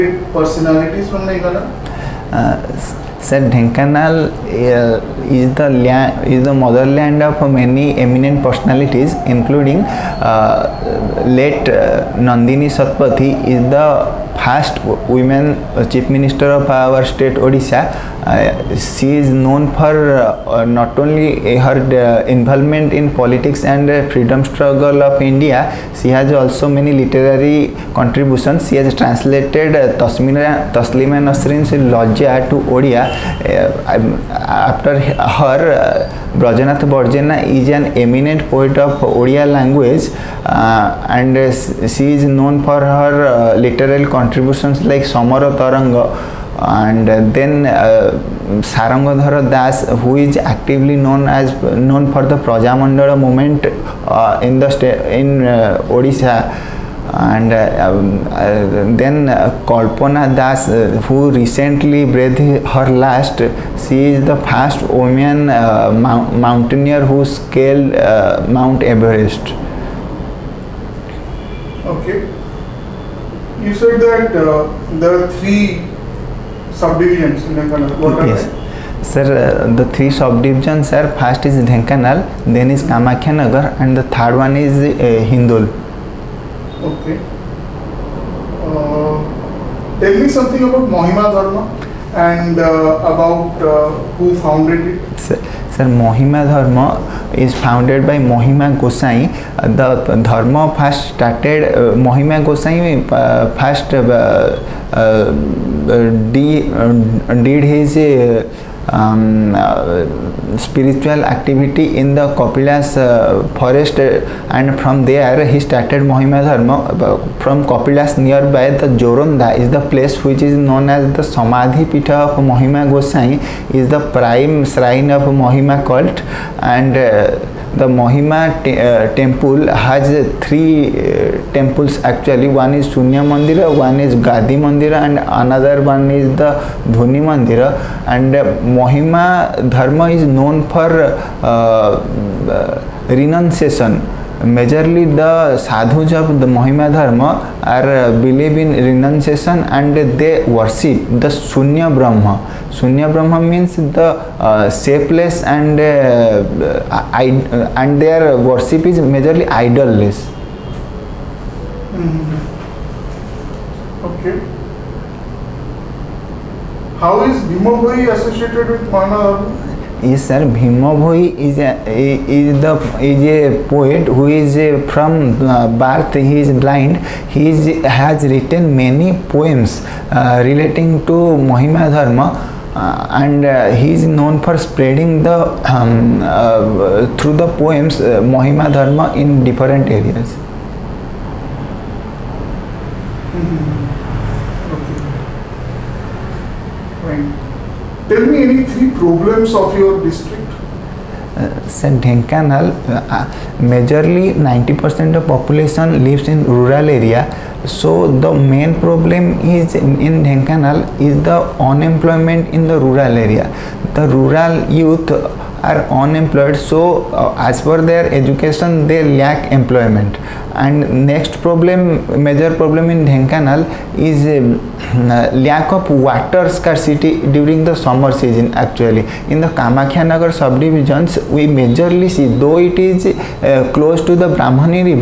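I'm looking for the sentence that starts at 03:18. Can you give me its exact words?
Tell me any three problems of your district.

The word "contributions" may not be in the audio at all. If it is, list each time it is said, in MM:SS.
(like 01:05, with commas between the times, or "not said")
00:27, 00:44.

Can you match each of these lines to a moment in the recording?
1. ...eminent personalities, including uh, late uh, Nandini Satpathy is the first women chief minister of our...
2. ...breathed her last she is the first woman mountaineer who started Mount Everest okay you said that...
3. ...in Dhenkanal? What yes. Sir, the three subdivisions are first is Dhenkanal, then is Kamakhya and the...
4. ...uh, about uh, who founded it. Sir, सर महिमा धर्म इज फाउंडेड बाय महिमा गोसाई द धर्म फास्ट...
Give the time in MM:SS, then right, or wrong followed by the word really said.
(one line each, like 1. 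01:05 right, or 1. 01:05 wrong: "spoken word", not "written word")
1. 00:07 right
2. 01:02 wrong: "scaled", not "started"
3. 01:17 right
4. 01:32 right.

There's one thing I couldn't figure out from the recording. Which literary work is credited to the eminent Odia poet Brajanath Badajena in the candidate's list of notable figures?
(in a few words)
Samara Taranga.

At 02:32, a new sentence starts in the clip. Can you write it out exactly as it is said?
Sunya Brahma means the uh, shapeless and uh, uh and their worship is majorly idolless.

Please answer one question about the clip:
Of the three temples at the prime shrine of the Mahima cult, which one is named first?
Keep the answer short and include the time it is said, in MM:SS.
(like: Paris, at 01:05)
Sunya Mandira, at 02:12.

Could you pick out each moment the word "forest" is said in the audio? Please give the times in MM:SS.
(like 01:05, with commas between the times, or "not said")
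01:53.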